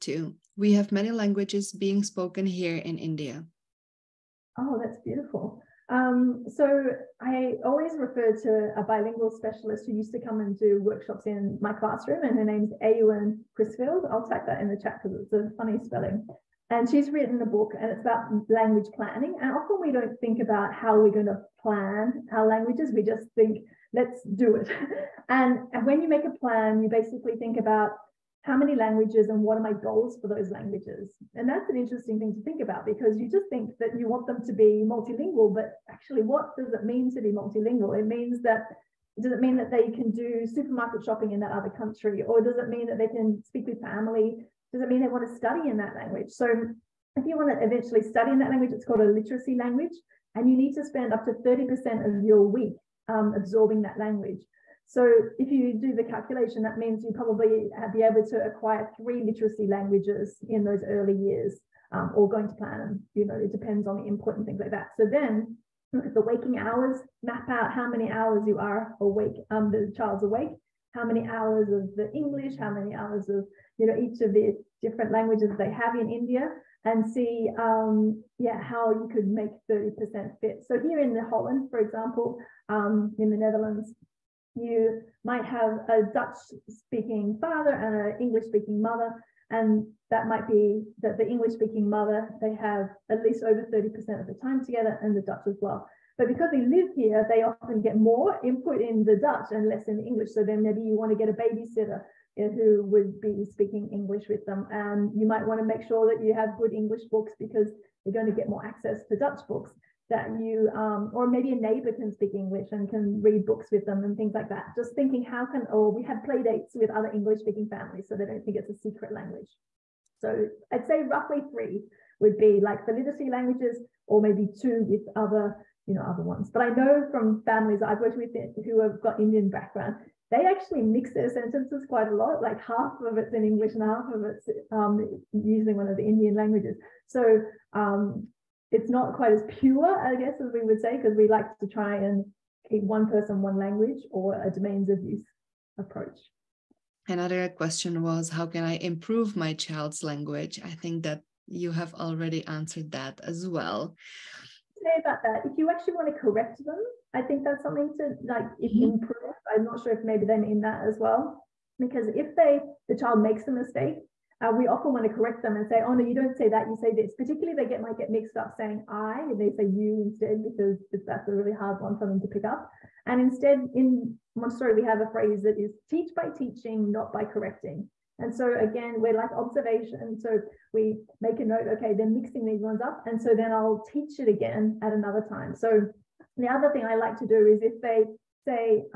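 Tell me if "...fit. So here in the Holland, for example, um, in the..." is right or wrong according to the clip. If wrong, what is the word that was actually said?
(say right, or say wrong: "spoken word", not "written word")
right.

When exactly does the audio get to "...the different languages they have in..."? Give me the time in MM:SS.
01:14.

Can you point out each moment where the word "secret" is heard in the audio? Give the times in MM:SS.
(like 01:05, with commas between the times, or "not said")
01:58.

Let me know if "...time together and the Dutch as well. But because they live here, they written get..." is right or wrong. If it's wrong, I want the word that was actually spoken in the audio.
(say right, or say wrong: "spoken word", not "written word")
wrong: "often", not "written".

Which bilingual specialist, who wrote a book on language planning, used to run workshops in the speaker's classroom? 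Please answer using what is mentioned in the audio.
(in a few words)
Eowyn Crisfield.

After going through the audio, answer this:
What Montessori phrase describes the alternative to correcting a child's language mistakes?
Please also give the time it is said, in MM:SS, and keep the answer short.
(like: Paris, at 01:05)
teach by teaching, not by correcting, at 02:55.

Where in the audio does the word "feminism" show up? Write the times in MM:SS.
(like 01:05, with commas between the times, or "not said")
not said.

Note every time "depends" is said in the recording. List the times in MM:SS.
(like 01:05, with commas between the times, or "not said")
01:03.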